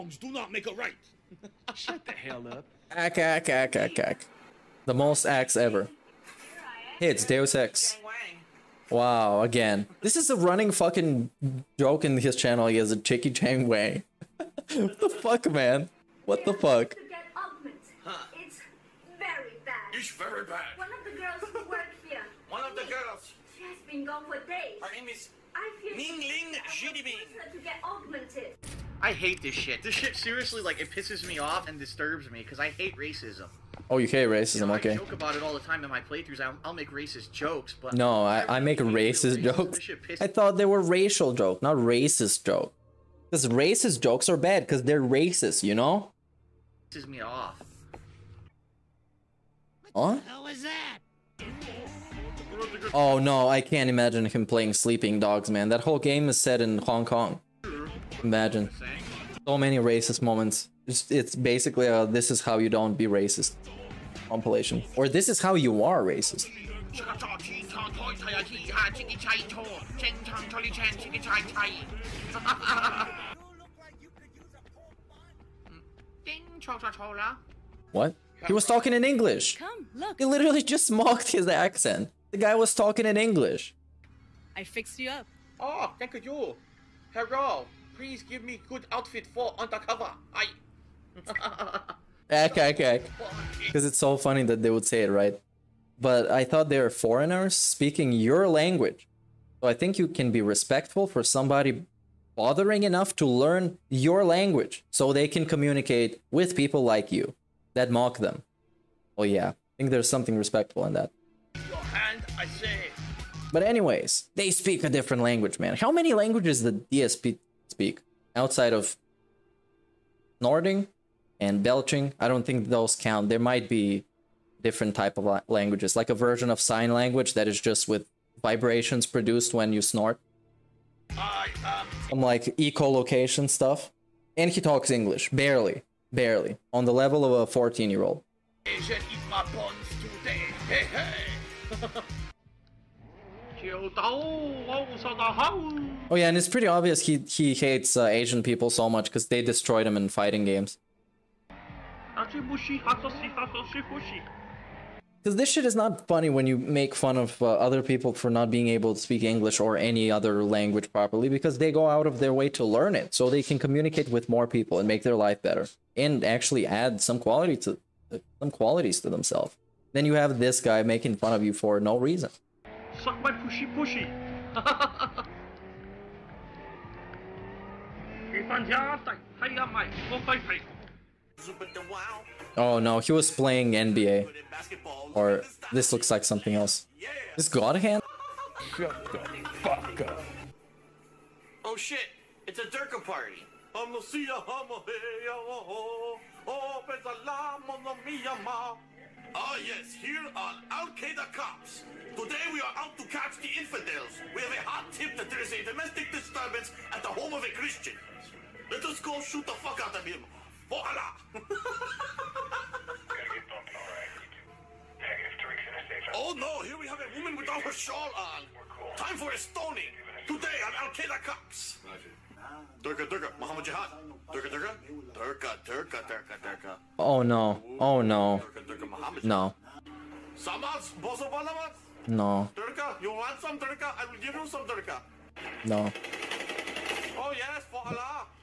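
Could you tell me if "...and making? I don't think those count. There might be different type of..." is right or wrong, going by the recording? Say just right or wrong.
wrong.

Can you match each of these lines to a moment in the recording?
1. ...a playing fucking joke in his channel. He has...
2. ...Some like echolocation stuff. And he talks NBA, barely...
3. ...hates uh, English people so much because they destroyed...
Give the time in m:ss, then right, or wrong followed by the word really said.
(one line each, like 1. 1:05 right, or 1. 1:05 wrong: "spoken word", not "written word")
1. 0:10 wrong: "running", not "playing"
2. 2:12 wrong: "English", not "NBA"
3. 2:27 wrong: "Asian", not "English".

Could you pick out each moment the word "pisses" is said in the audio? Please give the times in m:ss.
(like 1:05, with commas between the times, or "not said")
0:30, 0:46.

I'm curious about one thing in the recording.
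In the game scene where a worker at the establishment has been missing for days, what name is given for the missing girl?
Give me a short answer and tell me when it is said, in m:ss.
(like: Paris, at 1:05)
Ling, at 0:24.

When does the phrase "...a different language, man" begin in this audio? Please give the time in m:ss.
1:54.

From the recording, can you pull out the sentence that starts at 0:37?
No, I, I, make racist, jokes.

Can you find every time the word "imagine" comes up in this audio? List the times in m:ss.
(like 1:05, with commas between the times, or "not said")
0:53, 0:58.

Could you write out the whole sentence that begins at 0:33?
Oh, you hate racism, you know, okay.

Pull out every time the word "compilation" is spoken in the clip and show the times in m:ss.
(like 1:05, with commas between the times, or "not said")
1:04.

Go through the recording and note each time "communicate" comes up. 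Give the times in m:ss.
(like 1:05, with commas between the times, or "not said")
1:45, 2:43.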